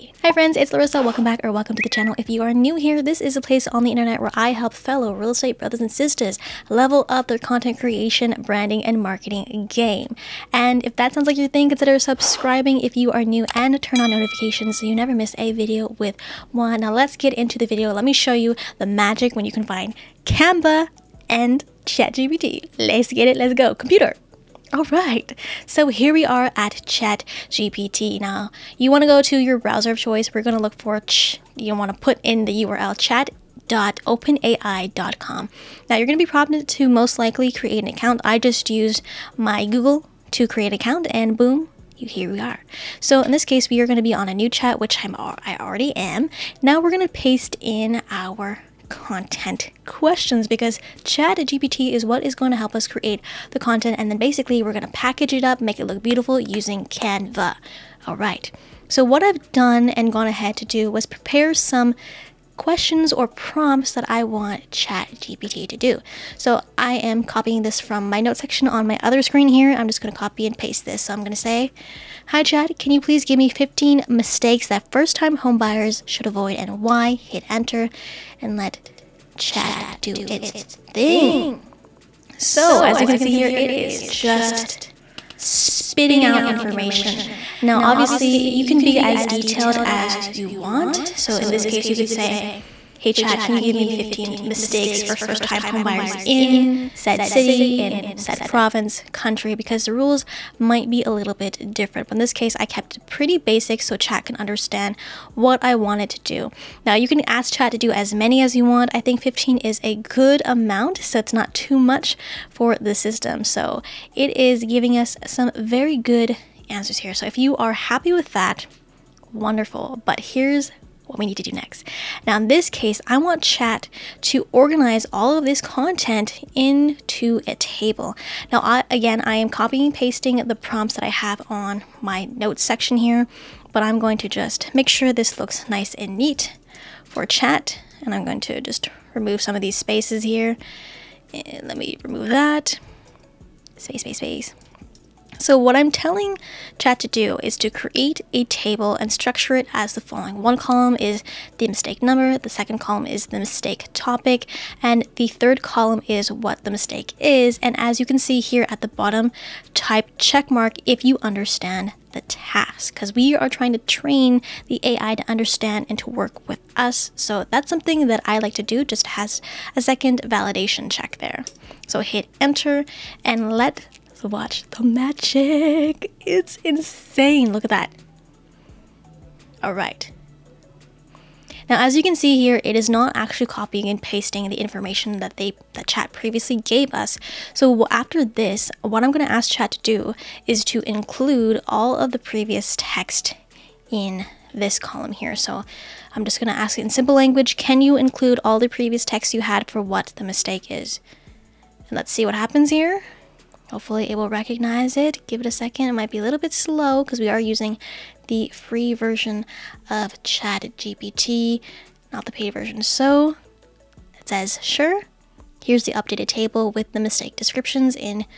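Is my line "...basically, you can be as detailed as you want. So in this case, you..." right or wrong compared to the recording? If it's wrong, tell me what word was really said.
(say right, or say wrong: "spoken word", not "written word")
wrong: "obviously", not "basically".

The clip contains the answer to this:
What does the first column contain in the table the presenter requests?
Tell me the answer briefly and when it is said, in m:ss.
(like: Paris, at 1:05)
mistake number, at 2:31.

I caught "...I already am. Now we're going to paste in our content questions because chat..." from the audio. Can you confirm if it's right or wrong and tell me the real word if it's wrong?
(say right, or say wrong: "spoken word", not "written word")
right.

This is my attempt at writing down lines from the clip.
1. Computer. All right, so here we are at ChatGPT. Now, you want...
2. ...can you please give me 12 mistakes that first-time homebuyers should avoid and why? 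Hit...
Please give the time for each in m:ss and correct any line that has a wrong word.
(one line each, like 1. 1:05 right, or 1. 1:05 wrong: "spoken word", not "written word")
1. 0:23 right
2. 1:12 wrong: "15", not "12".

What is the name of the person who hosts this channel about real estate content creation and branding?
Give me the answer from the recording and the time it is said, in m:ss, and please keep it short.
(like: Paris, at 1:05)
Laressa, at 0:00.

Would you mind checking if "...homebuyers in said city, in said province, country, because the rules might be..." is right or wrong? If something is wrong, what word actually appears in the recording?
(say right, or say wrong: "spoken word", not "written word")
right.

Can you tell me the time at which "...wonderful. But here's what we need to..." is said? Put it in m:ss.
1:59.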